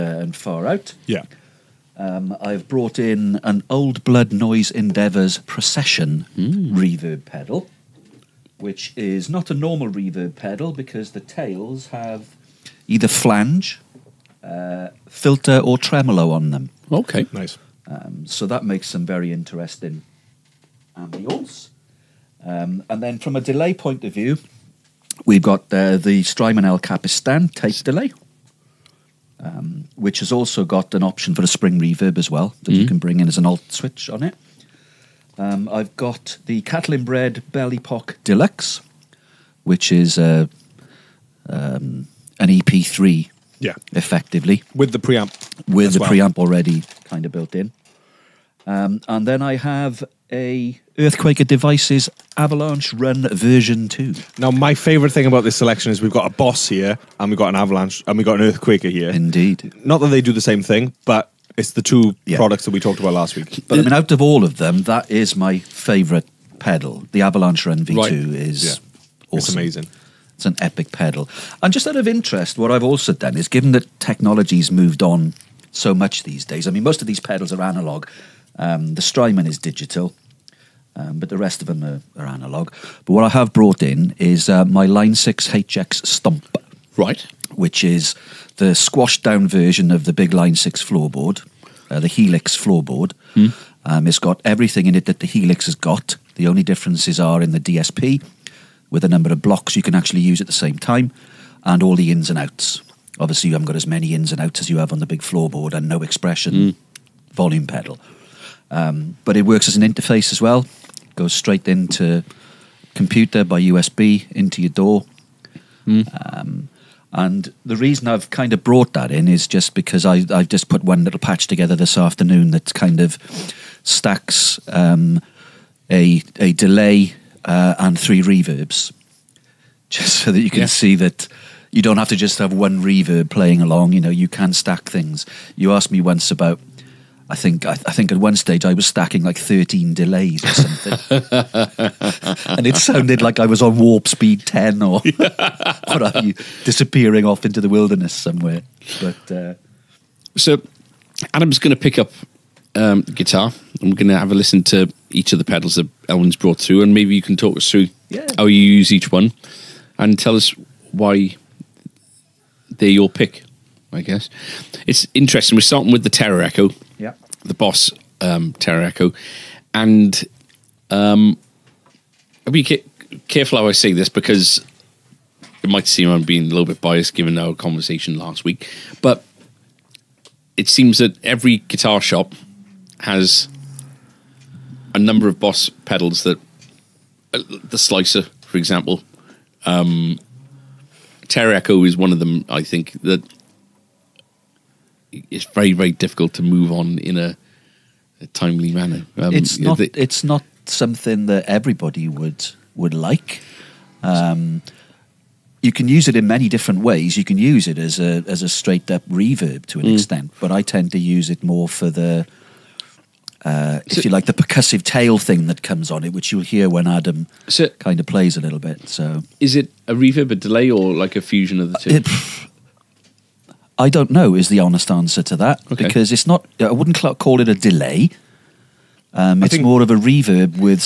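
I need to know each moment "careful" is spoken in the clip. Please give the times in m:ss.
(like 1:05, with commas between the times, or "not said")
2:53.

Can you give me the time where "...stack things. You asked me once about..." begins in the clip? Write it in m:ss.
2:14.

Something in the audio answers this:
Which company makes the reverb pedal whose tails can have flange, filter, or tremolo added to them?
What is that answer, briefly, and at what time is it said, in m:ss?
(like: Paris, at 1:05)
Old Blood Noise Endeavours, at 0:03.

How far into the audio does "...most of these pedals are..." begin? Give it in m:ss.
1:16.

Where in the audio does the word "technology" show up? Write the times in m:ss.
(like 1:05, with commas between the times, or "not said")
1:14.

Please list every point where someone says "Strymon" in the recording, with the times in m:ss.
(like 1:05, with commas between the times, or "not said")
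0:26, 1:19.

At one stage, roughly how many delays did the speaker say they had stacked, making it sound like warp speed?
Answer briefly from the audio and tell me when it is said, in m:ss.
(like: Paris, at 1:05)
13, at 2:19.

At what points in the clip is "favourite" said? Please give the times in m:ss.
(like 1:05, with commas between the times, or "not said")
0:54, 1:05.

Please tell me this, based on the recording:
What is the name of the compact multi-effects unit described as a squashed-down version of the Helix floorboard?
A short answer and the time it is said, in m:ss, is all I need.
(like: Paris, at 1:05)
HX Stump, at 1:25.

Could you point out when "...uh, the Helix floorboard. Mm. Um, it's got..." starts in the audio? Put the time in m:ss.
1:31.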